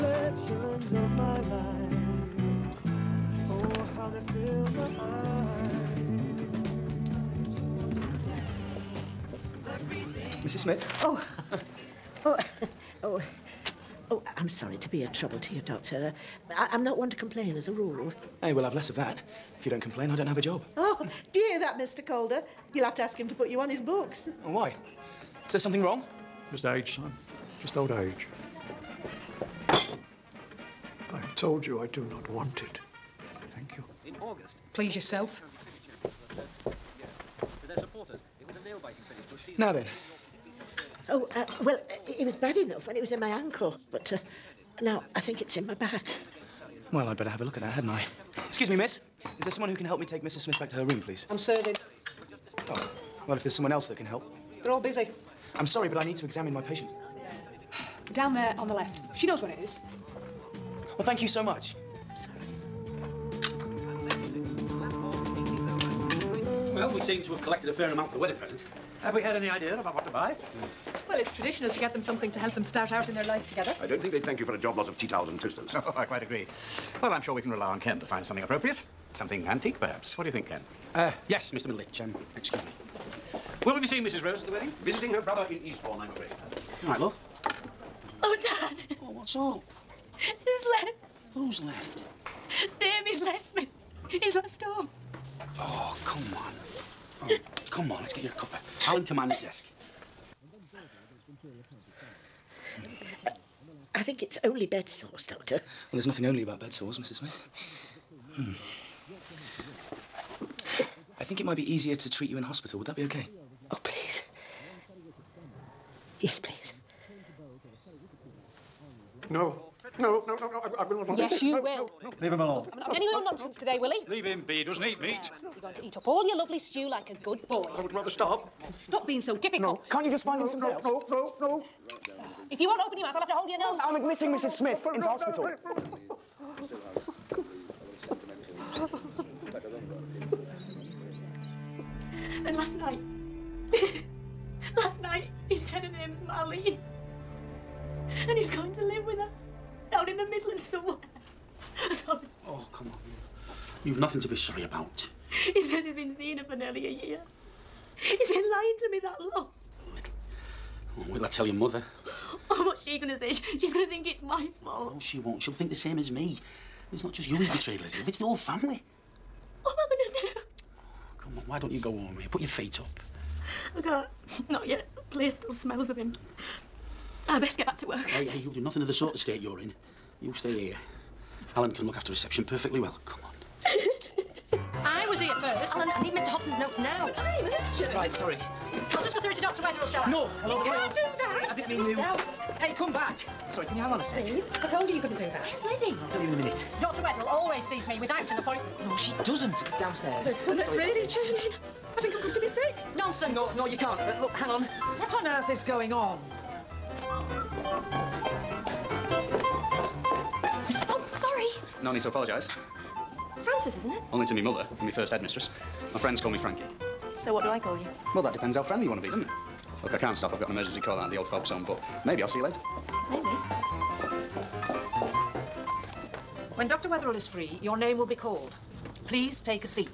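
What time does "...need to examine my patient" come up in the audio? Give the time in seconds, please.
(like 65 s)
56 s.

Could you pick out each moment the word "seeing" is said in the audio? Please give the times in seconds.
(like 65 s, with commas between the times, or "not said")
83 s, 156 s.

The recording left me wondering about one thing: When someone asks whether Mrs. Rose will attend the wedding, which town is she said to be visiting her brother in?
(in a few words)
Eastbourne.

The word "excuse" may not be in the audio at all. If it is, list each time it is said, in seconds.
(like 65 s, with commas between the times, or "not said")
48 s, 82 s.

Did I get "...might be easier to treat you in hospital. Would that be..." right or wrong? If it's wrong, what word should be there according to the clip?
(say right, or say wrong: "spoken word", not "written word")
right.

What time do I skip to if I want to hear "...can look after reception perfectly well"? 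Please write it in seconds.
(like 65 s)
181 s.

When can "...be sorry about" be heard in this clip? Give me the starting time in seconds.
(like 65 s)
154 s.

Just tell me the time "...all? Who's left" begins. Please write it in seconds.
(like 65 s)
89 s.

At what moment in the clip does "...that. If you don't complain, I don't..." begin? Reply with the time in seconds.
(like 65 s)
18 s.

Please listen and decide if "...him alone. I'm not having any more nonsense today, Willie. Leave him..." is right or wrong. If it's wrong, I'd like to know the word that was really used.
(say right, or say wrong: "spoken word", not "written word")
right.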